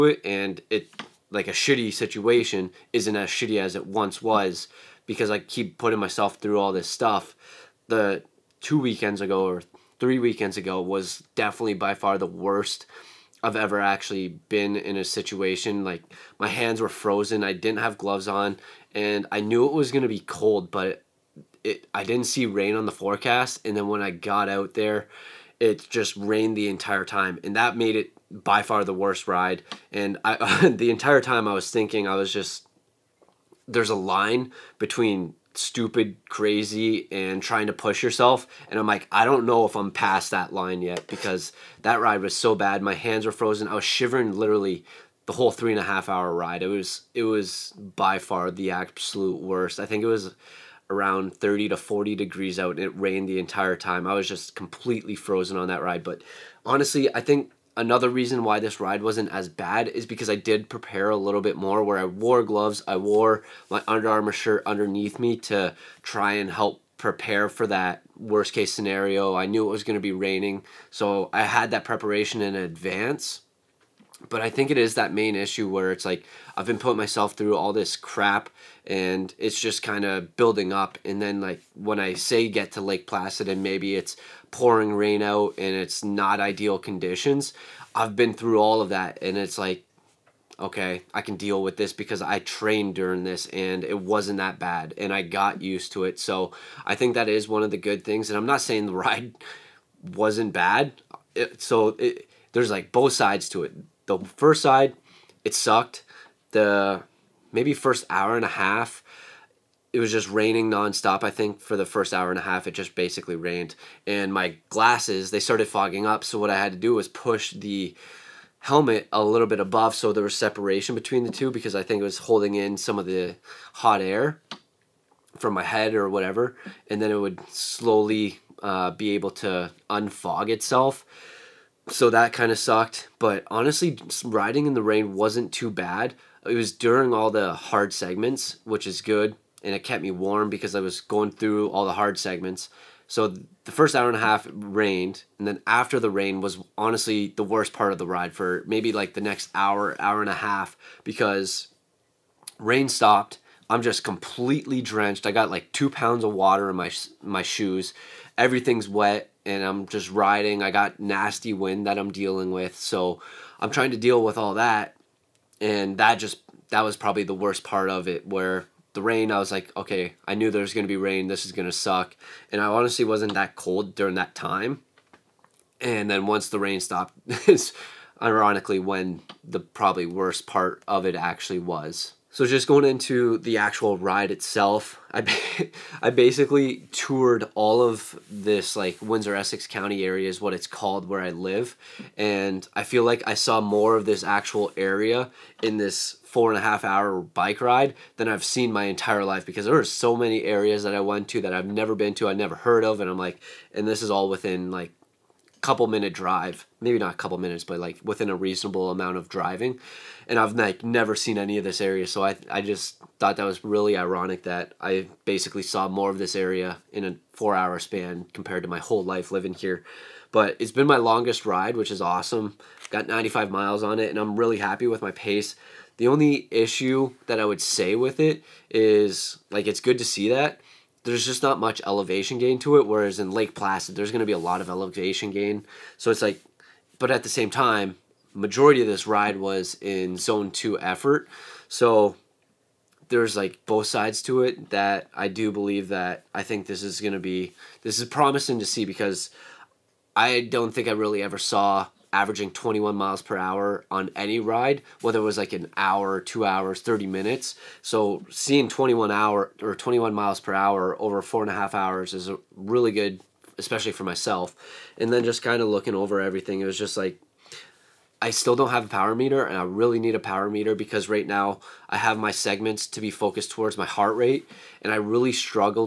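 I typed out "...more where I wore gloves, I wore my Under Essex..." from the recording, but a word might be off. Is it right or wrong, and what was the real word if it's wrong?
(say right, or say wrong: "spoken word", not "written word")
wrong: "Armour", not "Essex".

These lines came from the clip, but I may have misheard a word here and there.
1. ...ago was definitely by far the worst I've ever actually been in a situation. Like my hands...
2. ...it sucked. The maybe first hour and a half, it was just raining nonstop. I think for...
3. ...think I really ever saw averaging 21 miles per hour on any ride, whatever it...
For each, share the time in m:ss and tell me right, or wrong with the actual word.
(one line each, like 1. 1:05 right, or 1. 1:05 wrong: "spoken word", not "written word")
1. 0:10 right
2. 1:45 right
3. 4:10 wrong: "whether", not "whatever".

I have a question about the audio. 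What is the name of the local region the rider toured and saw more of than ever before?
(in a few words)
Windsor Essex County.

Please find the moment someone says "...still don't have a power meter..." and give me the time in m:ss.
4:28.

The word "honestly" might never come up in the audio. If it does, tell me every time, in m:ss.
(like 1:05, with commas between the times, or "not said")
0:56, 2:13, 2:26, 2:52.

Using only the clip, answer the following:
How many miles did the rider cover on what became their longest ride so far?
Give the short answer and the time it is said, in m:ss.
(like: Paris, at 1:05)
95, at 3:43.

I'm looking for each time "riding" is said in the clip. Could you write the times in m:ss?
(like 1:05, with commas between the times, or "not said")
2:14, 2:40.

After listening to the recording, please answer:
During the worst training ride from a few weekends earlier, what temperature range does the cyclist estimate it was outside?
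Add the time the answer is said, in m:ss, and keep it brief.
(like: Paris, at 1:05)
30 to 40 degrees, at 0:51.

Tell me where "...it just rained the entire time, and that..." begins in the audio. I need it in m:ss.
0:25.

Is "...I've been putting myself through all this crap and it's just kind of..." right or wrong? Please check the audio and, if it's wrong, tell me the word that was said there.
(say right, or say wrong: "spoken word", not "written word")
right.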